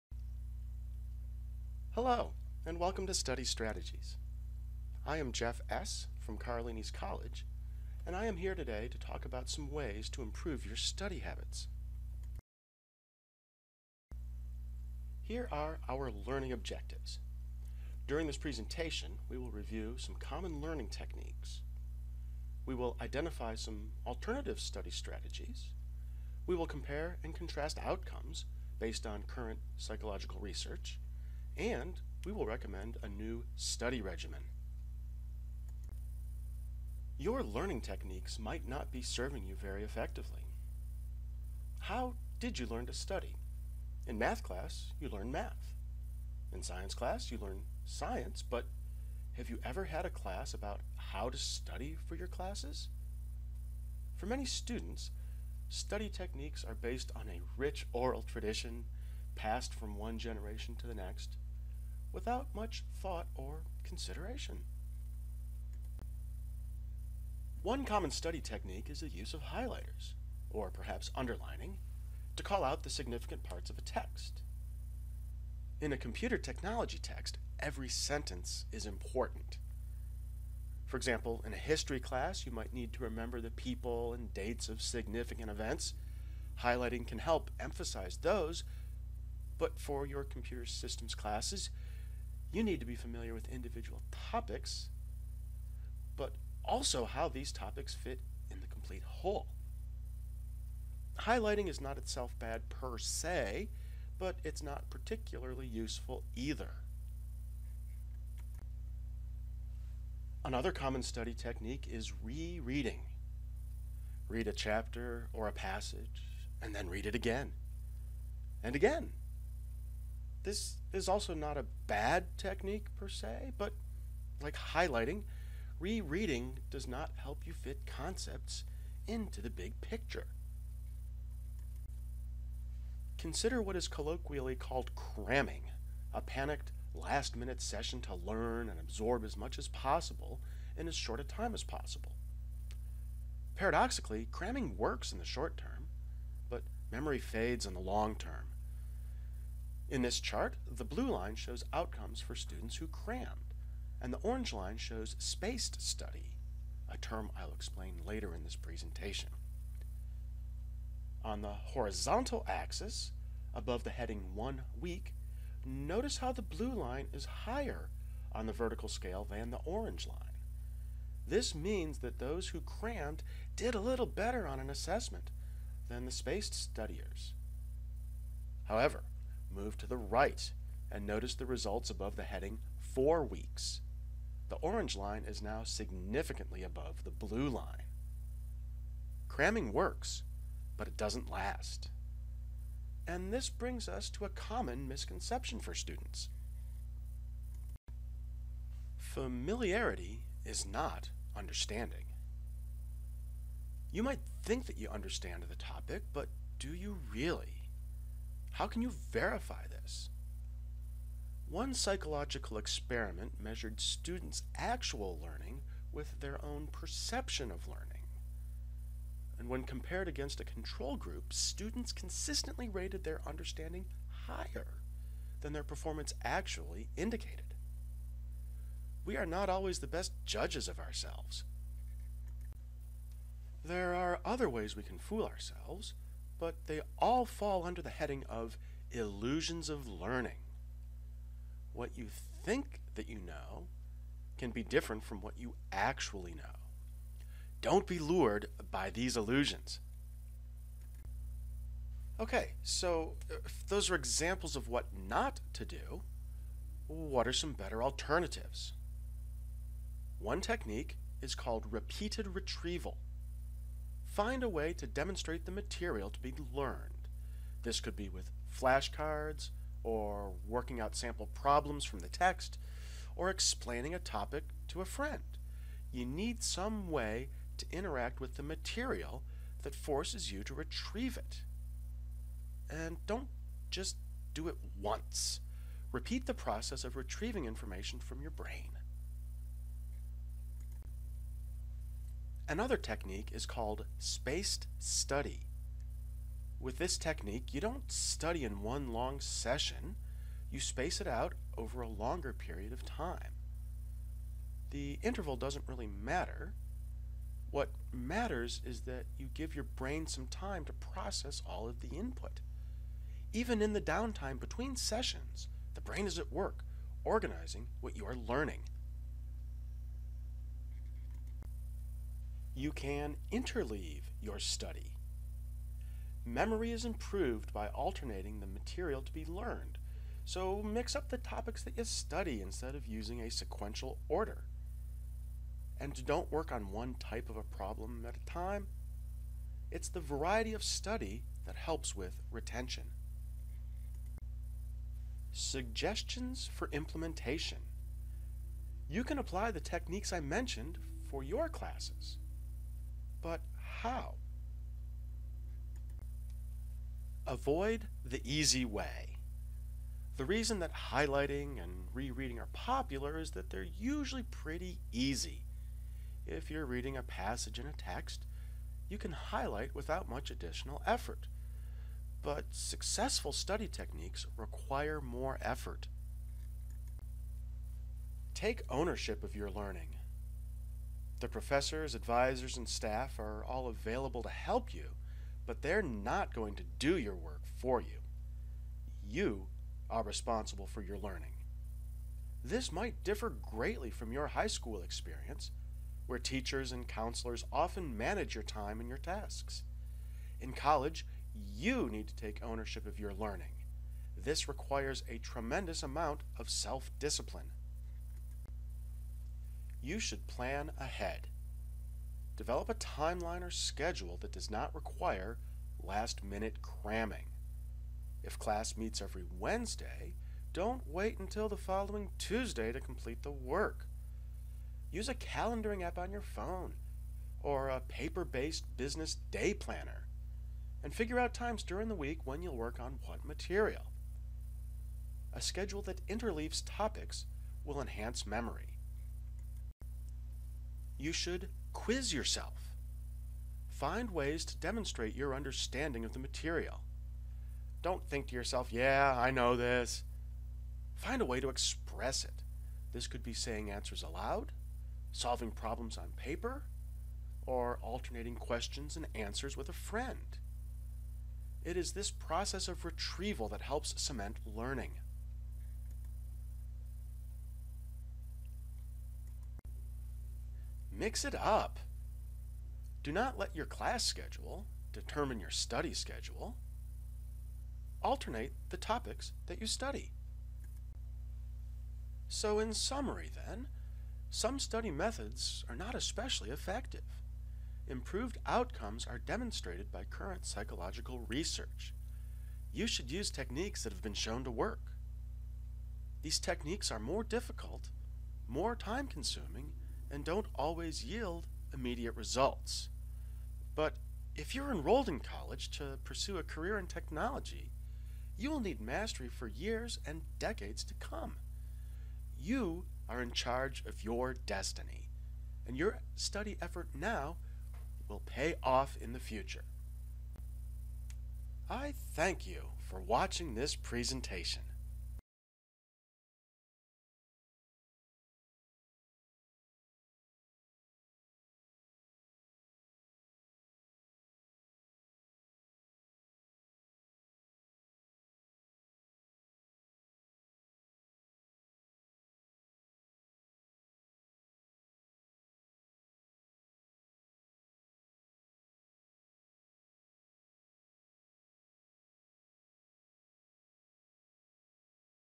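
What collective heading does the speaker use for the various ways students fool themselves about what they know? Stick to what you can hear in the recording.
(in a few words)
Illusions of learning.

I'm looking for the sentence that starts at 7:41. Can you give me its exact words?
It is this process of retrieval that helps cement learning.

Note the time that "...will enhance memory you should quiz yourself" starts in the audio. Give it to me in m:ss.
7:17.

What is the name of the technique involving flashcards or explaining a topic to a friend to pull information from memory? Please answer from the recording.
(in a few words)
Repeated retrieval.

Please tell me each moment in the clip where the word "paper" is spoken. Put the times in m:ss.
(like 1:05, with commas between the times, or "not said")
7:07, 7:36.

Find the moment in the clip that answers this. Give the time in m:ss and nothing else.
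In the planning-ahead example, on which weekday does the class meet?
6:59.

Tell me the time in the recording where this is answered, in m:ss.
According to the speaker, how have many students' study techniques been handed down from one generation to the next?
0:57.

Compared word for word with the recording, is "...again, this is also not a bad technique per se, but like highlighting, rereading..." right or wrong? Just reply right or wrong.
right.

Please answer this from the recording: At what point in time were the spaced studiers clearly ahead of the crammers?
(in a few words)
4 weeks.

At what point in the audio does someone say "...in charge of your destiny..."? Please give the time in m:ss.
8:33.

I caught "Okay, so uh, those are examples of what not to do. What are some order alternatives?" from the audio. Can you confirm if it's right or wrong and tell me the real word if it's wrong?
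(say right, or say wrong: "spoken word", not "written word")
wrong: "better", not "order".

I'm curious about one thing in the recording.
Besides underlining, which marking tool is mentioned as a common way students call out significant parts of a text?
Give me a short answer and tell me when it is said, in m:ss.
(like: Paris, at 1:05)
Highlighters, at 1:09.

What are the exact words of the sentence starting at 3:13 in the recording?
And this brings us to a common misconception for students.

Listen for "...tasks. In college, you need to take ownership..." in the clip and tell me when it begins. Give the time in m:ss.
6:38.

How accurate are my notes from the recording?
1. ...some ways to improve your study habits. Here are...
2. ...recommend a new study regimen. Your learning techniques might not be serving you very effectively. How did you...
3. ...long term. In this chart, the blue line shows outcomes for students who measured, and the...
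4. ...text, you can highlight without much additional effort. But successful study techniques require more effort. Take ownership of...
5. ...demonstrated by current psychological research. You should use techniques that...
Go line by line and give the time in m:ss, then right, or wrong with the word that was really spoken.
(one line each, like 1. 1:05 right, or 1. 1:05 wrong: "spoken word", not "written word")
1. 0:09 right
2. 0:32 right
3. 2:27 wrong: "crammed", not "measured"
4. 6:07 right
5. 8:09 right.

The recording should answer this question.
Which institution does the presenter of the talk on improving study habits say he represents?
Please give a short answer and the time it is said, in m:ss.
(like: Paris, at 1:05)
Carlini's College, at 0:06.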